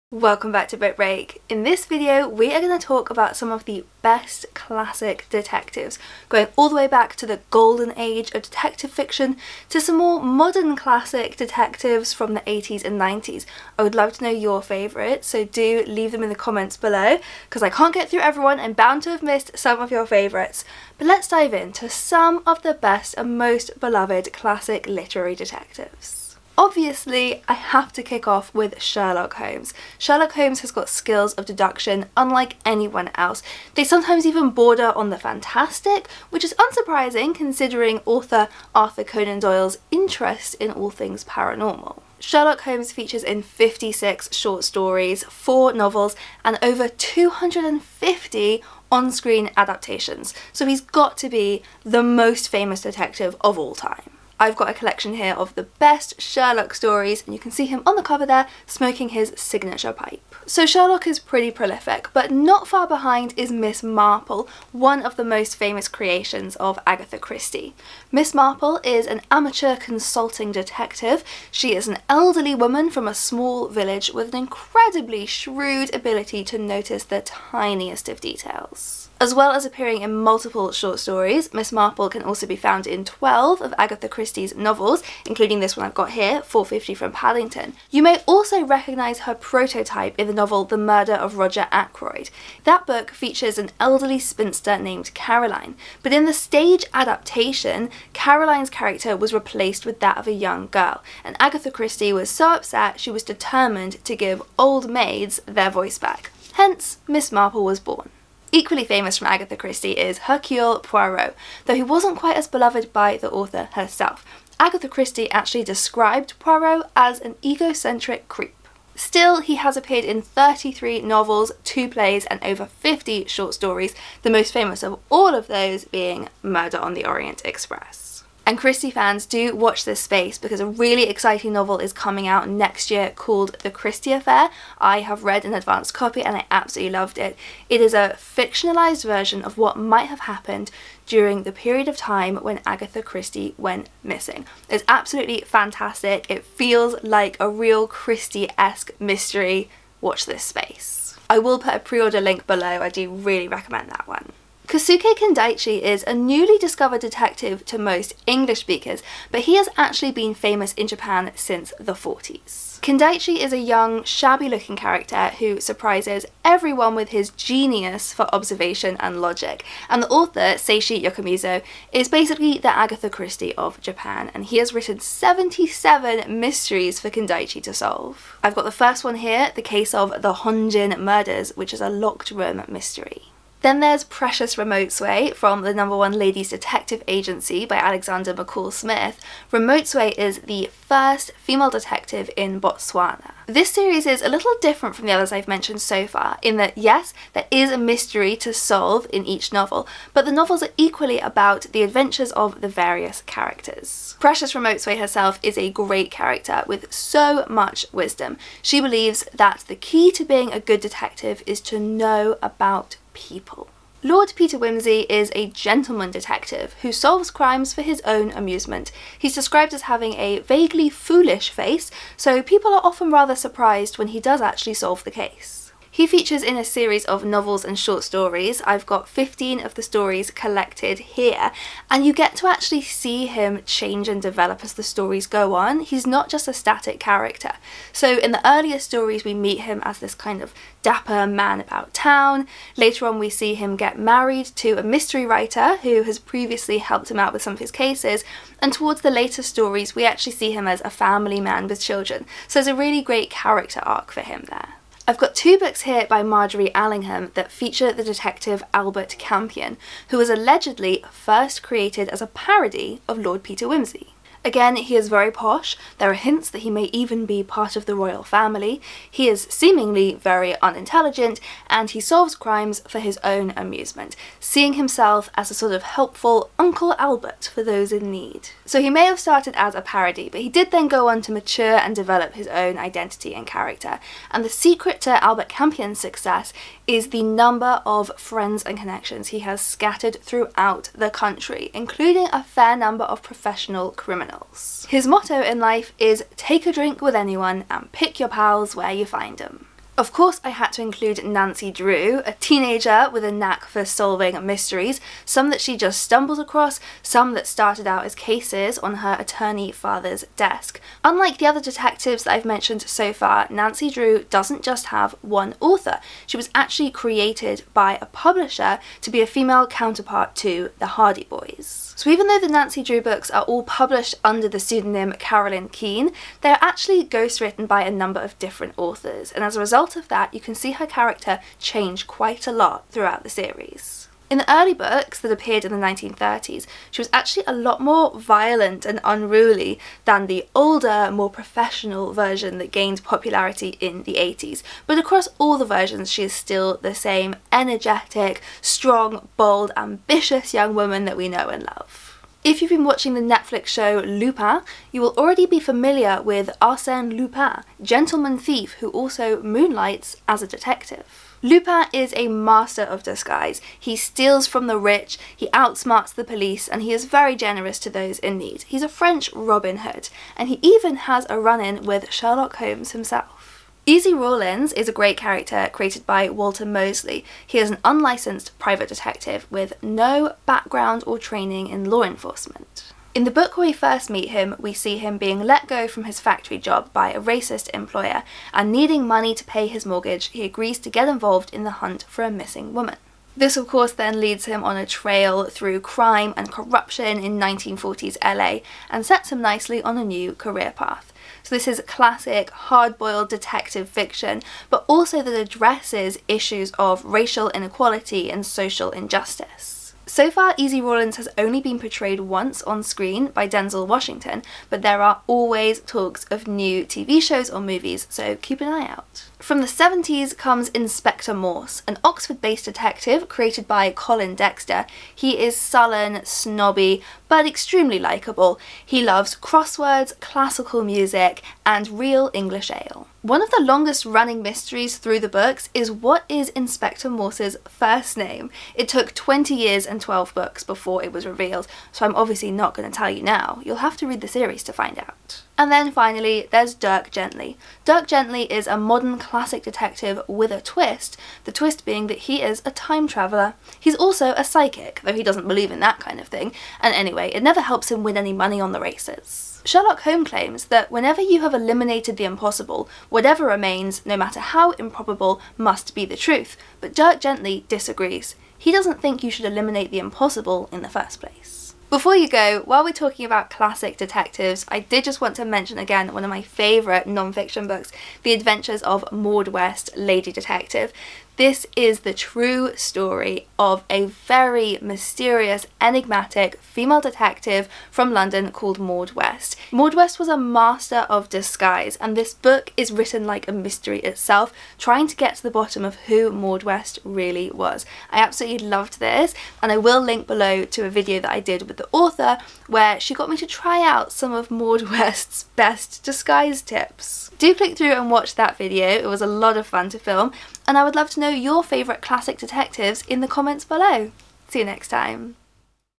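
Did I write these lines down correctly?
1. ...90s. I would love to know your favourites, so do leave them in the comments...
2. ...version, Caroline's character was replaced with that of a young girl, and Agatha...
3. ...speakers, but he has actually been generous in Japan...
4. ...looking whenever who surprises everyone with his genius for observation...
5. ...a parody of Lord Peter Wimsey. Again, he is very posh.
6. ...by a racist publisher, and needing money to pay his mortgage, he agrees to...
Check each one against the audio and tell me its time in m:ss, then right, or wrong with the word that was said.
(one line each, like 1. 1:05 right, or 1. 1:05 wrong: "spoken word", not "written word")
1. 0:12 right
2. 1:36 wrong: "adaptation", not "version"
3. 2:38 wrong: "famous", not "generous"
4. 2:44 wrong: "character", not "whenever"
5. 4:22 right
6. 6:26 wrong: "employer", not "publisher".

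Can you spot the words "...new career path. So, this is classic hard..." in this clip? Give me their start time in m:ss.
6:40.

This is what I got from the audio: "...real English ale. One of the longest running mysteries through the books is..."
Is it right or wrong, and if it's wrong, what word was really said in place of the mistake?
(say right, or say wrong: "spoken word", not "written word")
right.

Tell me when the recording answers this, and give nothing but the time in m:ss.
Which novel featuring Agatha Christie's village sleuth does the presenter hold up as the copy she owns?
1:26.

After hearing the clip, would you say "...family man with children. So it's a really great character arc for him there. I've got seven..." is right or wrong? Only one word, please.
wrong.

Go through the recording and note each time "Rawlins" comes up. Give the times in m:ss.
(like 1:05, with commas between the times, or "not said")
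6:14, 6:50.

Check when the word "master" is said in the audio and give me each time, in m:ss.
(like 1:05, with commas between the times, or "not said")
6:02, 8:10.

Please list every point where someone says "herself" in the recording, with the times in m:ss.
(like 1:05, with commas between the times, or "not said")
1:53, 3:24.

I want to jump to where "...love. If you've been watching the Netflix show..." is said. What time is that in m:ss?
5:51.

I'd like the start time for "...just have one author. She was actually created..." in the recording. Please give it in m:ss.
5:14.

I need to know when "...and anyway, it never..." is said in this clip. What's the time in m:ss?
7:36.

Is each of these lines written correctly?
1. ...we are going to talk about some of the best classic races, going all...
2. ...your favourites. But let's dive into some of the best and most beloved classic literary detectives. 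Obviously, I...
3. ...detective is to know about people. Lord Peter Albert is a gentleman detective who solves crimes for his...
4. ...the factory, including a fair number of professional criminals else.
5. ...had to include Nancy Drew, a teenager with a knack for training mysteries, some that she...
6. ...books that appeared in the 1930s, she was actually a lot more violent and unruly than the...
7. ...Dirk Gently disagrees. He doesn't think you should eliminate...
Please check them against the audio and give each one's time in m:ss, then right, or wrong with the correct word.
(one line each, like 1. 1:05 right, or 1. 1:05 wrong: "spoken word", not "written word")
1. 0:02 wrong: "detectives", not "races"
2. 0:19 right
3. 3:30 wrong: "Wimsey", not "Albert"
4. 4:50 wrong: "country", not "factory"
5. 5:00 wrong: "solving", not "training"
6. 5:34 right
7. 7:46 right.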